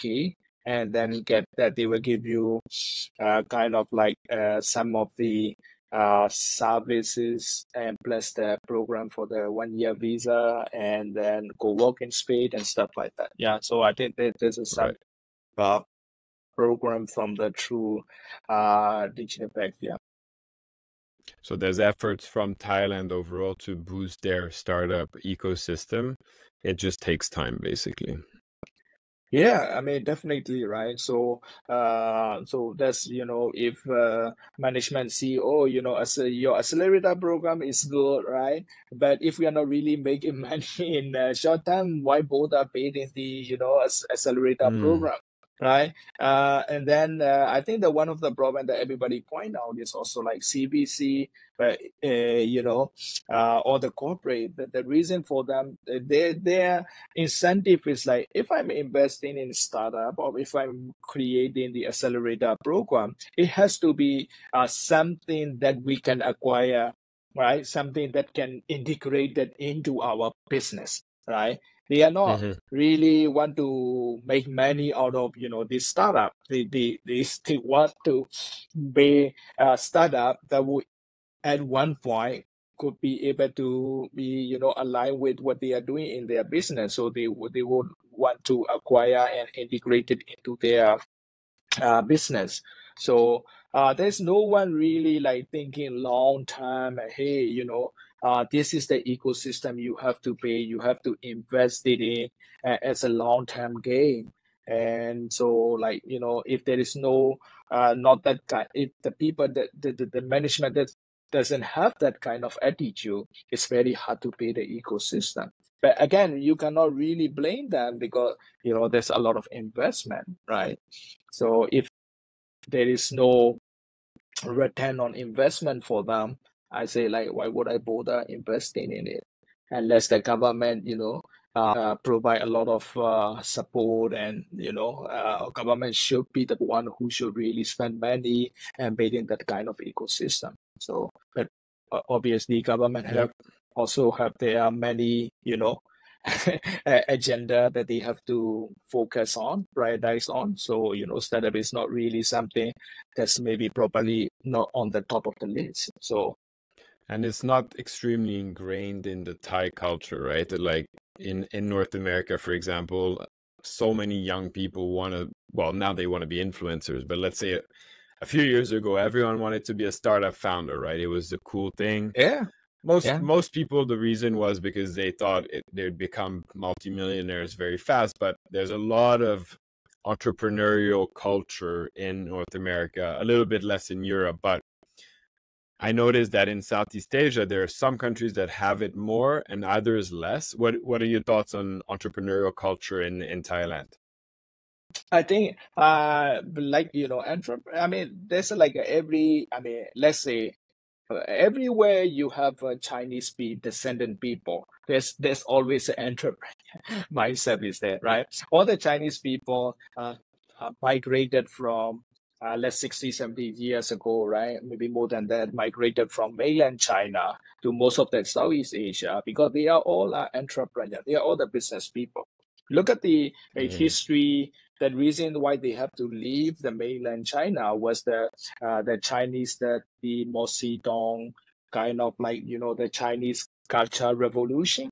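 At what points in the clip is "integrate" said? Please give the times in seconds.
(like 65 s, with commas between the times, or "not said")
68 s, 89 s.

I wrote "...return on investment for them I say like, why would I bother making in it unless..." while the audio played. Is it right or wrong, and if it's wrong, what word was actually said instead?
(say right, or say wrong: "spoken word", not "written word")
wrong: "investing", not "making".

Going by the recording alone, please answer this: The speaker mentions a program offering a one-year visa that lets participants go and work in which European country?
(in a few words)
Spain.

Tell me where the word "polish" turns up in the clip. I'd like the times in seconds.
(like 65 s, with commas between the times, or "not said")
not said.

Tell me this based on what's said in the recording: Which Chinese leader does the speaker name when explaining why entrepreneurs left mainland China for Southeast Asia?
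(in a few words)
Mao Zedong.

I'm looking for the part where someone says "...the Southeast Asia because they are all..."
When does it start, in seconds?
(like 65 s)
218 s.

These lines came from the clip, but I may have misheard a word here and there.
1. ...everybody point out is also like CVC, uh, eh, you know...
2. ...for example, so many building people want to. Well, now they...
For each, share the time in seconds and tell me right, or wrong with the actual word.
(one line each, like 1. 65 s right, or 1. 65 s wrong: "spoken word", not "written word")
1. 48 s right
2. 162 s wrong: "young", not "building".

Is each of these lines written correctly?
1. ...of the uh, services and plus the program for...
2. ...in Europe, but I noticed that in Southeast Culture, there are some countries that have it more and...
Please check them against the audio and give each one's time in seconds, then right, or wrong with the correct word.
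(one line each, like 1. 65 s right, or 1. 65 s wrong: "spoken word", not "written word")
1. 4 s right
2. 183 s wrong: "Asia", not "Culture".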